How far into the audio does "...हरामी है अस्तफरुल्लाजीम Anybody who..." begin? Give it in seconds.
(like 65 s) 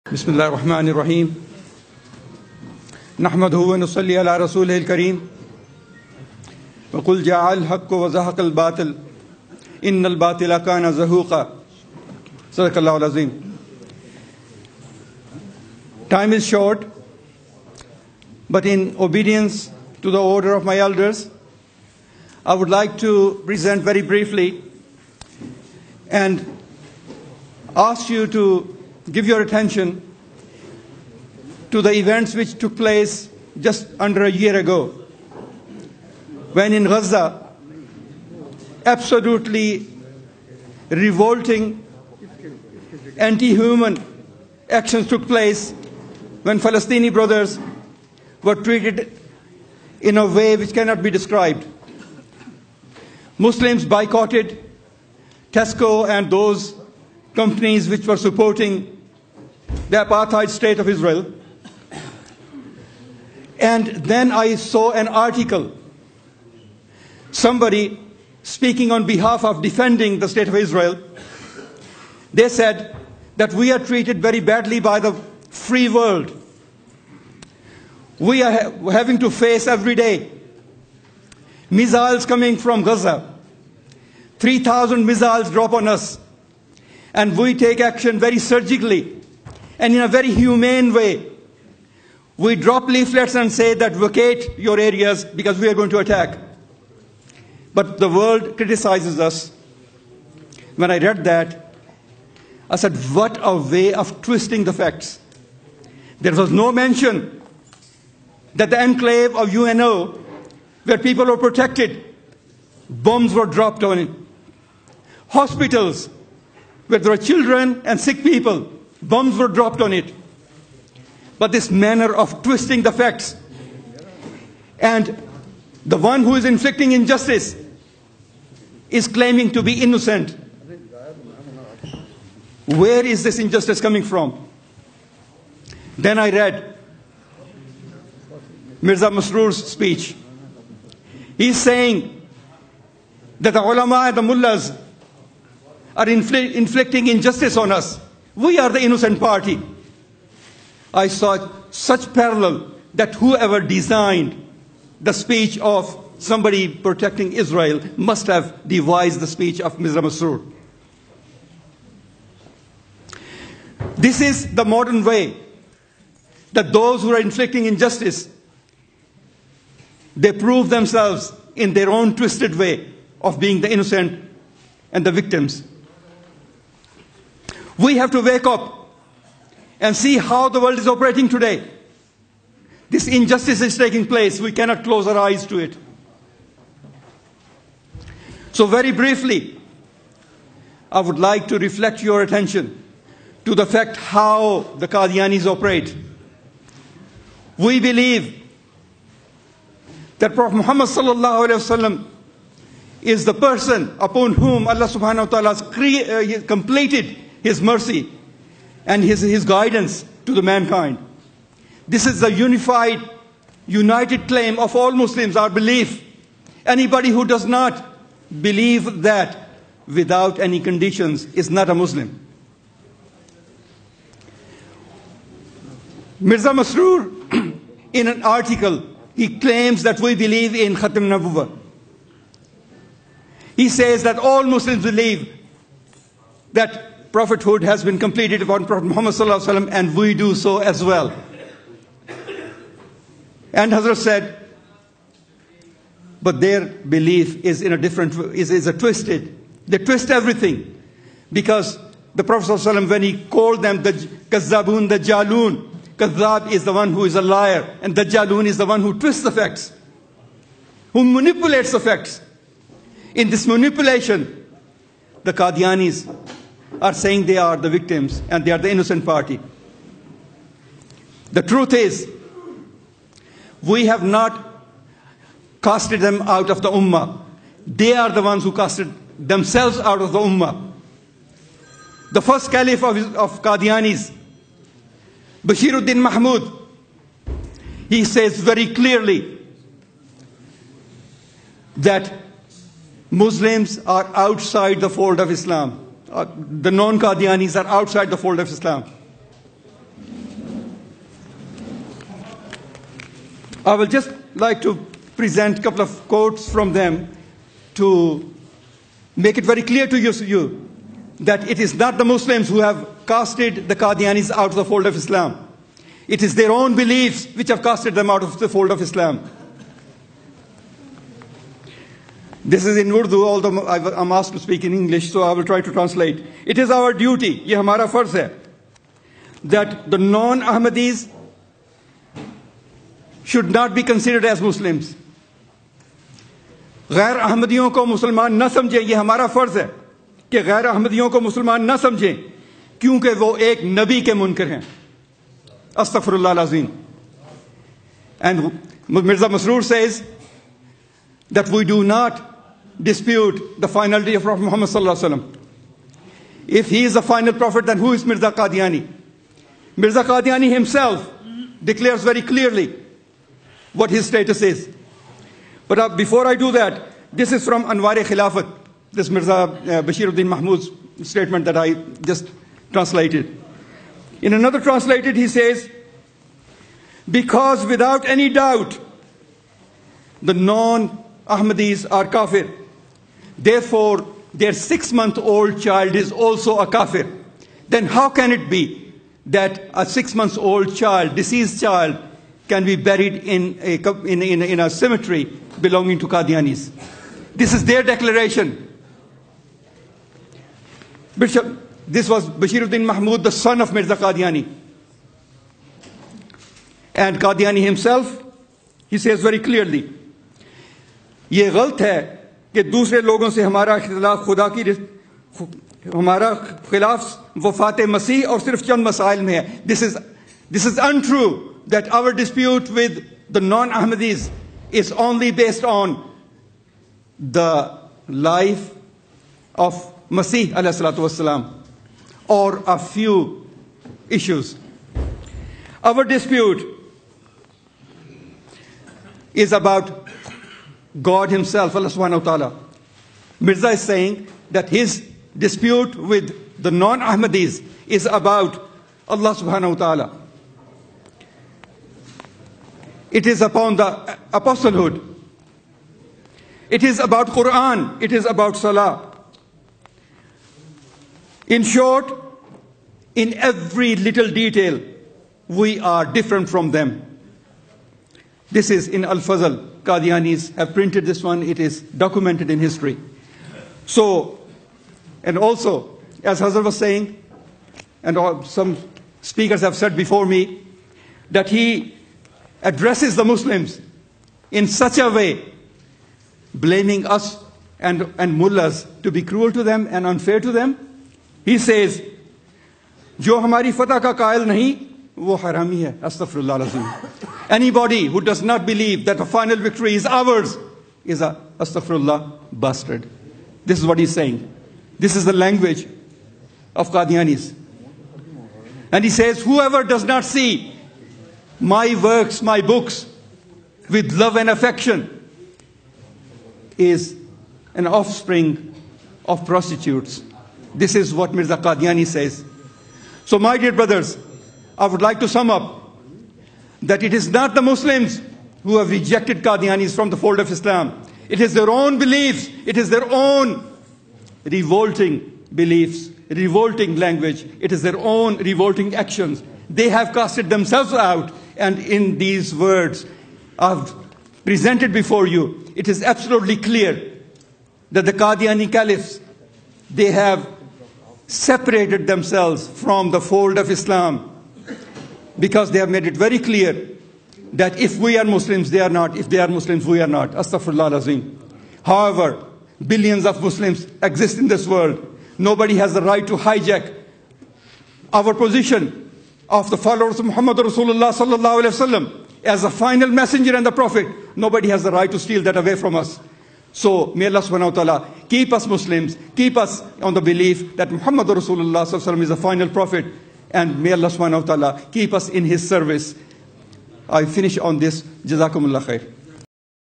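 495 s.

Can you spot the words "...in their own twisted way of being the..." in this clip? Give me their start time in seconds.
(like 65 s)
171 s.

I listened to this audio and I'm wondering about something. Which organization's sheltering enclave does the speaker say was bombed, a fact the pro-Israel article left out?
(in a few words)
UNO.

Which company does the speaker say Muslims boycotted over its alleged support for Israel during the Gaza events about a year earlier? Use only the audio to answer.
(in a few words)
Tesco.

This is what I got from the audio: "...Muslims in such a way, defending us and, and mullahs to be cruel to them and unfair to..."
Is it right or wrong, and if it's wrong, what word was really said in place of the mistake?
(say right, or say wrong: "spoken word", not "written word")
wrong: "blaming", not "defending".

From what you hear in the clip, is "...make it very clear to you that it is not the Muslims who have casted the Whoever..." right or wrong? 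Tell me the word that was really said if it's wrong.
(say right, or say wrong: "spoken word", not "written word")
wrong: "Qadianis", not "Whoever".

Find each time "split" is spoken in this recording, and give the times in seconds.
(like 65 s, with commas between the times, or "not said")
not said.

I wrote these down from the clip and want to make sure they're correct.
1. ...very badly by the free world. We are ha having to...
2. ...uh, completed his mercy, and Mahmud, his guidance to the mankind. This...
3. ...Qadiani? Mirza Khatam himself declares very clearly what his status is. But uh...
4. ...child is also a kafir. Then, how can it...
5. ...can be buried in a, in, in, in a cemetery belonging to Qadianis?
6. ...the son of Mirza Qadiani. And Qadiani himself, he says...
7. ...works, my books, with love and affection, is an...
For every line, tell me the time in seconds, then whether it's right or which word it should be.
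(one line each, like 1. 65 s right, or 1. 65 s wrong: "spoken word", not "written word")
1. 74 s right
2. 205 s wrong: "His", not "Mahmud"
3. 358 s wrong: "Qadiani", not "Khatam"
4. 385 s right
5. 392 s right
6. 403 s right
7. 512 s right.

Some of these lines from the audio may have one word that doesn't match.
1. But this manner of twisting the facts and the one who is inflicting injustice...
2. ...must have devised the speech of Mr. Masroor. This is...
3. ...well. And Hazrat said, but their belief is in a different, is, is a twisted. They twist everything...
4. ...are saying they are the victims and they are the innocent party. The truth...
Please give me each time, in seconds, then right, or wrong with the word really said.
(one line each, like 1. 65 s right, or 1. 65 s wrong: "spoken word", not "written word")
1. 121 s right
2. 157 s right
3. 240 s right
4. 266 s right.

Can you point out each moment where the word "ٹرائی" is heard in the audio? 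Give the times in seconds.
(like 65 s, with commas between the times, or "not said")
325 s.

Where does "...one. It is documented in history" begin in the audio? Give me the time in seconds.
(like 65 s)
471 s.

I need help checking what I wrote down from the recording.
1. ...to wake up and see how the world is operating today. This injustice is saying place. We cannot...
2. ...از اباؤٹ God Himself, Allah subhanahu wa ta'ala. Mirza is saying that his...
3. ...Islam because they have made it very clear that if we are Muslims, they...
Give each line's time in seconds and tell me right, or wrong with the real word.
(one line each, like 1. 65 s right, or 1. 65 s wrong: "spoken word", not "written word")
1. 178 s wrong: "taking", not "saying"
2. 439 s right
3. 553 s right.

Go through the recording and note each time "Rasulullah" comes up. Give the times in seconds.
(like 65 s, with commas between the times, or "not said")
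570 s, 581 s.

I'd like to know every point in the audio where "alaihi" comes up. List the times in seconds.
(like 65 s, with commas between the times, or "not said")
571 s, 581 s.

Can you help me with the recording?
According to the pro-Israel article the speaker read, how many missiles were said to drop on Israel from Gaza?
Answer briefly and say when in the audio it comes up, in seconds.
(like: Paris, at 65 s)
3,000, at 84 s.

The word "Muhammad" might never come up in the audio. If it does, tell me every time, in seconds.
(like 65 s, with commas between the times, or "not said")
200 s, 238 s, 354 s, 570 s, 580 s.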